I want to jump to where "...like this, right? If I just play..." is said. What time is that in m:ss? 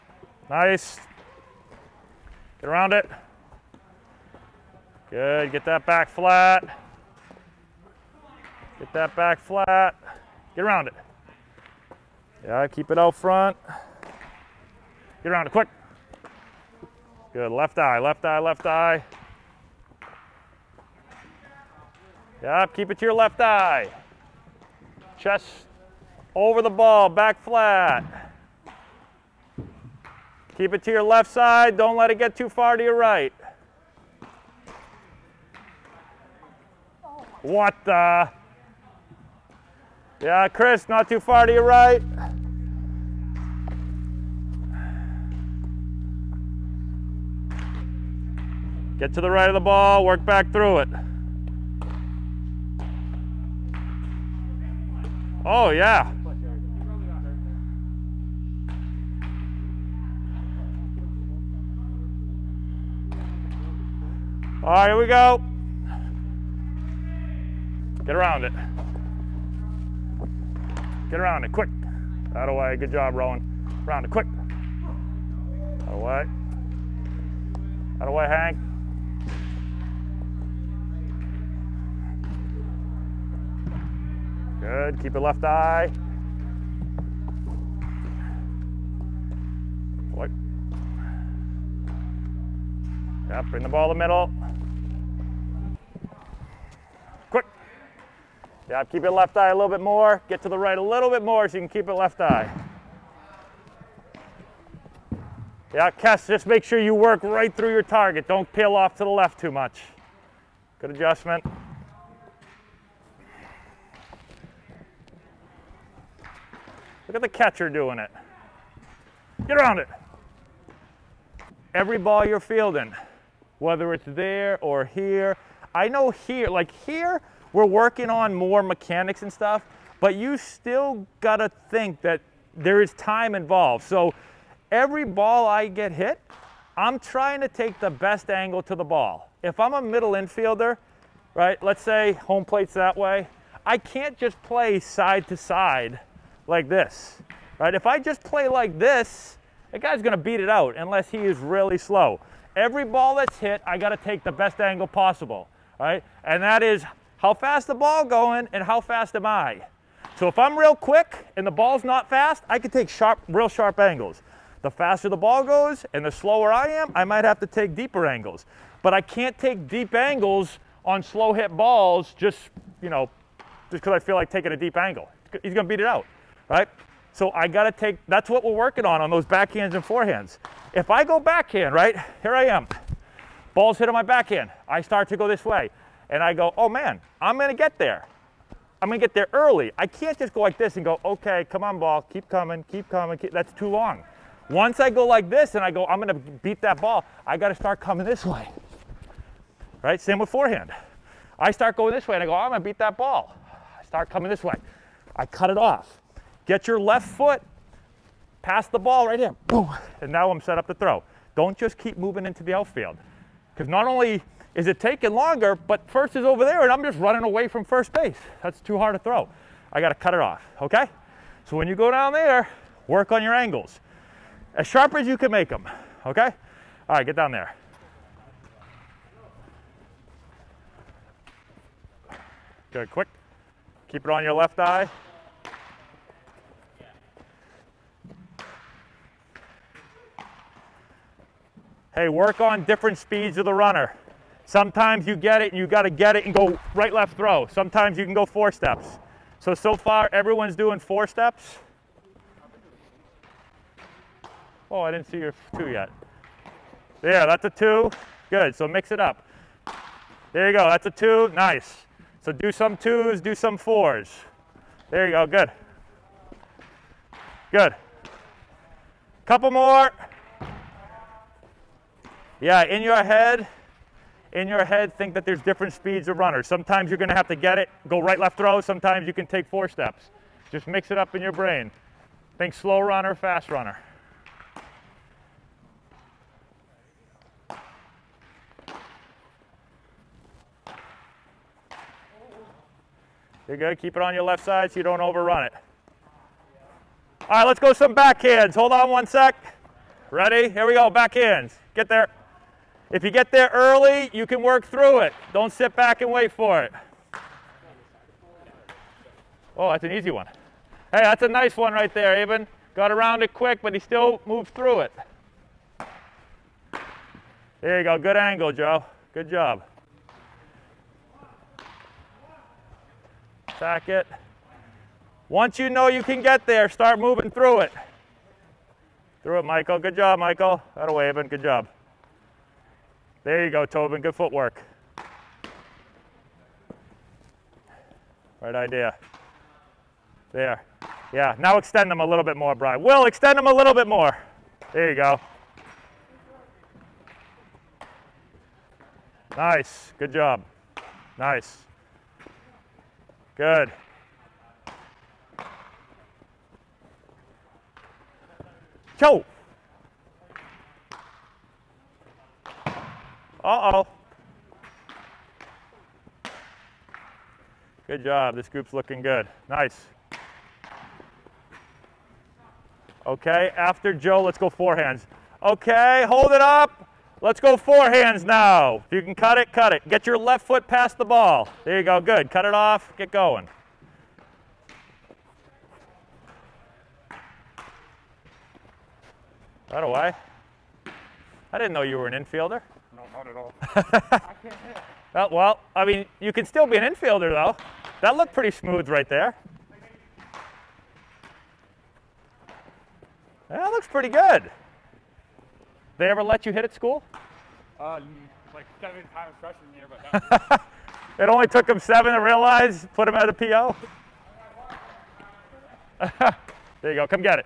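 2:26.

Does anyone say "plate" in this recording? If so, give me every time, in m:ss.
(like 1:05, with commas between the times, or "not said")
2:22.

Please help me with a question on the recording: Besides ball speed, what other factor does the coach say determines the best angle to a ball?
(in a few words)
How fast am I.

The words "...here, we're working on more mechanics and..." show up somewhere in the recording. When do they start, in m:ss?
2:06.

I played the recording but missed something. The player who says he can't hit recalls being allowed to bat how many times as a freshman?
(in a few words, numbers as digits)
7.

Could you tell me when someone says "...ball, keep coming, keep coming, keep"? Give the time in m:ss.
3:11.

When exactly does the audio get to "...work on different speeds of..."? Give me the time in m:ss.
4:02.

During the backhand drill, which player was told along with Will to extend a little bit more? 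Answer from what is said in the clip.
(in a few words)
Brian.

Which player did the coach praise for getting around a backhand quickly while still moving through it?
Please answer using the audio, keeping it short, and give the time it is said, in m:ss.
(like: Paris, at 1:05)
Aben, at 5:12.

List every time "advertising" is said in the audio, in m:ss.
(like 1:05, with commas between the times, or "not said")
not said.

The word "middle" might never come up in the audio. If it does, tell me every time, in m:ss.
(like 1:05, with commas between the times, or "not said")
1:33, 2:19.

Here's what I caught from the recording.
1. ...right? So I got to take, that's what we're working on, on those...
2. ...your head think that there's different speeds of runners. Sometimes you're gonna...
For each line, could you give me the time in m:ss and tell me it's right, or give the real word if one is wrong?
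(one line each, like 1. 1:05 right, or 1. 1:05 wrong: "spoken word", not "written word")
1. 2:56 right
2. 4:34 right.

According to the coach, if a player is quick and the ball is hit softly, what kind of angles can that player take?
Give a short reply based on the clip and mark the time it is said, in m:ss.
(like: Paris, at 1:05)
Real sharp angles, at 2:43.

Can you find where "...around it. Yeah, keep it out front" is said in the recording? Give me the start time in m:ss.
0:10.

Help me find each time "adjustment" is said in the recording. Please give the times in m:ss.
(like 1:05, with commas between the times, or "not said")
1:50.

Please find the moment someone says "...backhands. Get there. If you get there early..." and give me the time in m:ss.
5:00.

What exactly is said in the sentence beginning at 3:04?
I start to go this way and I go, oh man, I'm gonna get there.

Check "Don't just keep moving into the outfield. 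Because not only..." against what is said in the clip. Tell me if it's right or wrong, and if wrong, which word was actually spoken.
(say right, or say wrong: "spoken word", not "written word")
right.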